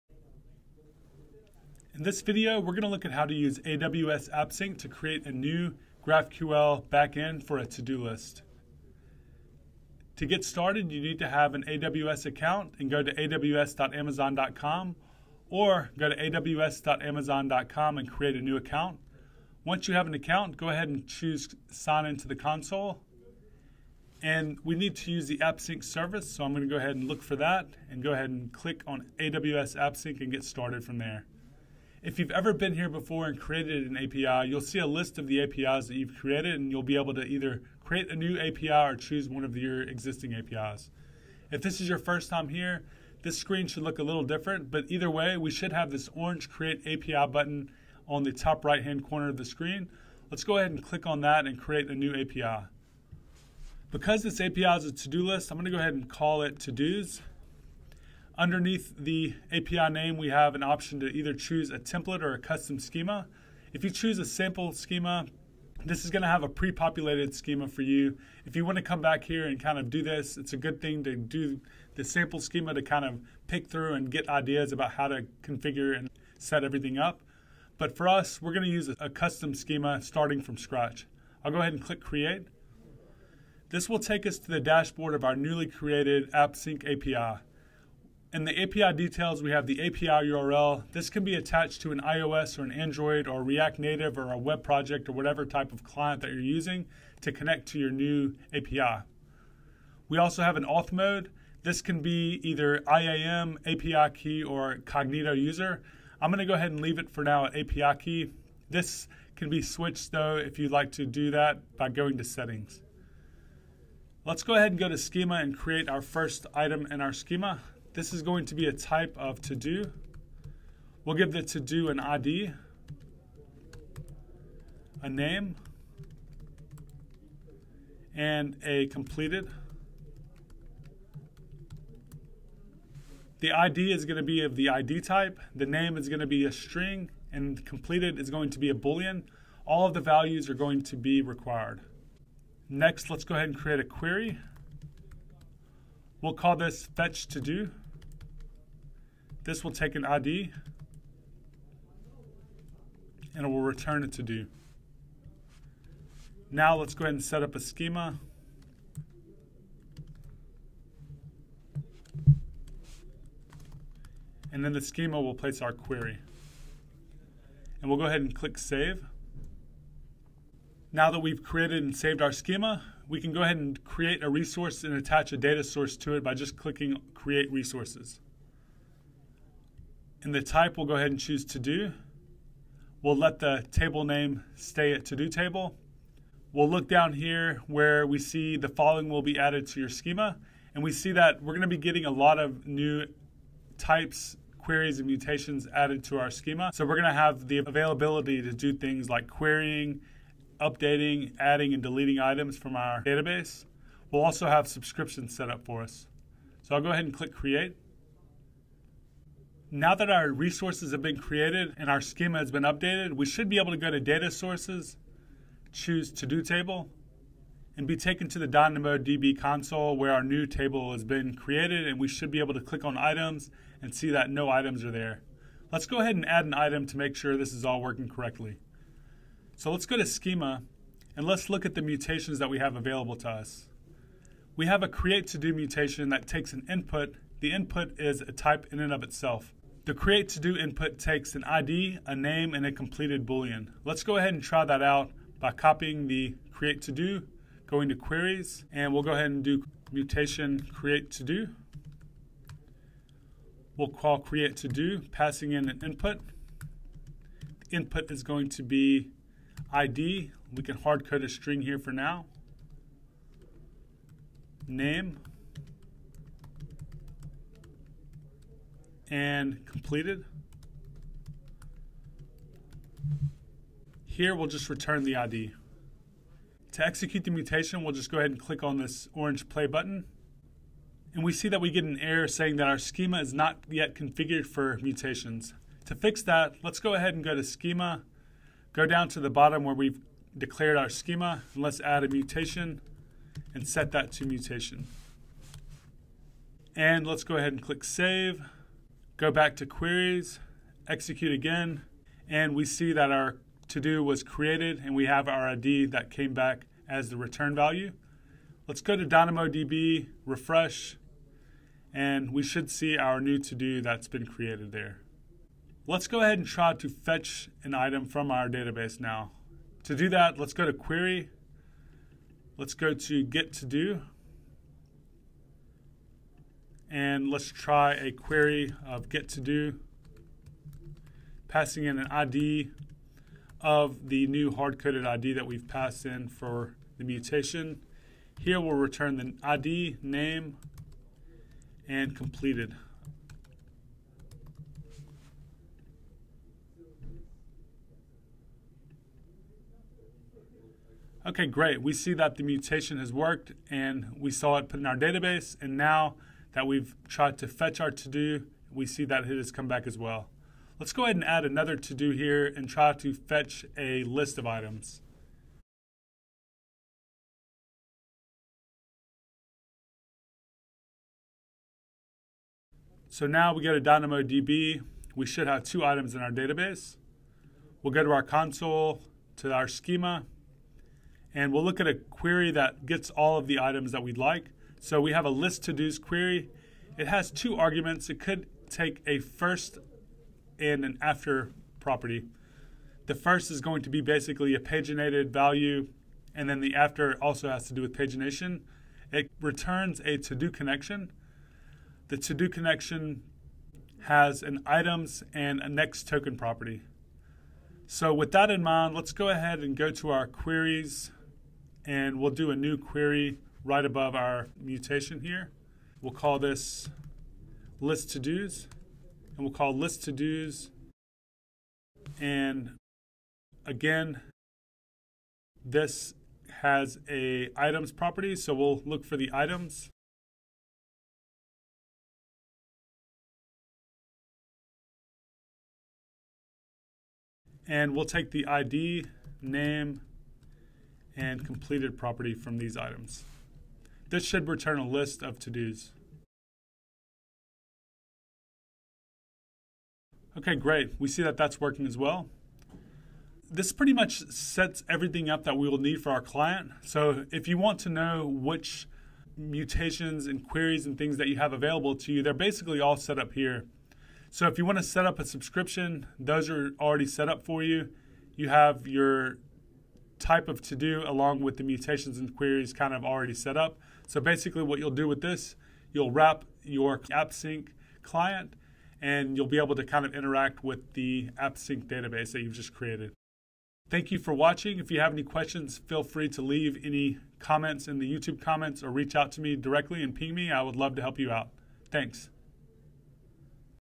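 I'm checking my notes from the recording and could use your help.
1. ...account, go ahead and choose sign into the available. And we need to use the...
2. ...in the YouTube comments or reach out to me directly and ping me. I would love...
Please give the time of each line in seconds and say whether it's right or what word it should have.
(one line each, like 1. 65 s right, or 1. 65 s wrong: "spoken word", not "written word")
1. 20 s wrong: "console", not "available"
2. 487 s right.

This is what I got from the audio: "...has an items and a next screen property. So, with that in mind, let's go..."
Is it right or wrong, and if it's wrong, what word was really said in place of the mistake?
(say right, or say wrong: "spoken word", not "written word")
wrong: "token", not "screen".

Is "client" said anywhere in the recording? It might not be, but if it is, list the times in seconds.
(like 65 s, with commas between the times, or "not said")
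95 s, 456 s, 478 s.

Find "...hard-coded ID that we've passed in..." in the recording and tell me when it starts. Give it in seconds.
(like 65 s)
334 s.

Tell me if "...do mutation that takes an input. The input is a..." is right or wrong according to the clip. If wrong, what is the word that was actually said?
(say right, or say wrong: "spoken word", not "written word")
right.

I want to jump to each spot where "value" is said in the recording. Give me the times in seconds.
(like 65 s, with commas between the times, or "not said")
140 s, 307 s, 395 s.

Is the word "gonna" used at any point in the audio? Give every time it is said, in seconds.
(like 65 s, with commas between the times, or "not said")
55 s, 106 s, 191 s, 196 s.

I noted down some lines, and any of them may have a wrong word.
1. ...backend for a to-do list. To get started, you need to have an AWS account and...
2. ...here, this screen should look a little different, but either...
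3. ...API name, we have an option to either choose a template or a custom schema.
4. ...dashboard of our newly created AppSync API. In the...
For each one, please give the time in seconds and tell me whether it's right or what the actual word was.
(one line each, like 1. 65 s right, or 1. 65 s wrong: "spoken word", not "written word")
1. 6 s right
2. 42 s right
3. 59 s right
4. 84 s right.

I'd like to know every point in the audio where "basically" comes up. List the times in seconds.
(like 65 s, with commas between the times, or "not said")
394 s, 462 s, 474 s.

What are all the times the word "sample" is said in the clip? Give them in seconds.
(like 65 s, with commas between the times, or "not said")
64 s, 72 s.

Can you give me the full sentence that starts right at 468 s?
You have your type of to do along with the mutations and queries kind of already set up.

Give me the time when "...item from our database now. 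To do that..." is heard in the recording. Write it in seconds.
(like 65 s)
317 s.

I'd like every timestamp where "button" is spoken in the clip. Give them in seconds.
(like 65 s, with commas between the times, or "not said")
47 s, 279 s.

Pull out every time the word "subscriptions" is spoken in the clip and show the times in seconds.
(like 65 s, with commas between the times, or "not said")
204 s, 465 s.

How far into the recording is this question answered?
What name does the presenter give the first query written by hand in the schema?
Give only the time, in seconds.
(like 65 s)
146 s.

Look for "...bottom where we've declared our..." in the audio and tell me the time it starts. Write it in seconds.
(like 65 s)
289 s.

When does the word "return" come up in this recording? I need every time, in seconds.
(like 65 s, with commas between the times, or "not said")
153 s, 274 s, 307 s, 338 s, 399 s, 444 s.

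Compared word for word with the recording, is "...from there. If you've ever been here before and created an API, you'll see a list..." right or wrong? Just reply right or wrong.
right.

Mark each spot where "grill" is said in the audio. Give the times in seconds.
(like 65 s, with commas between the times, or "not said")
not said.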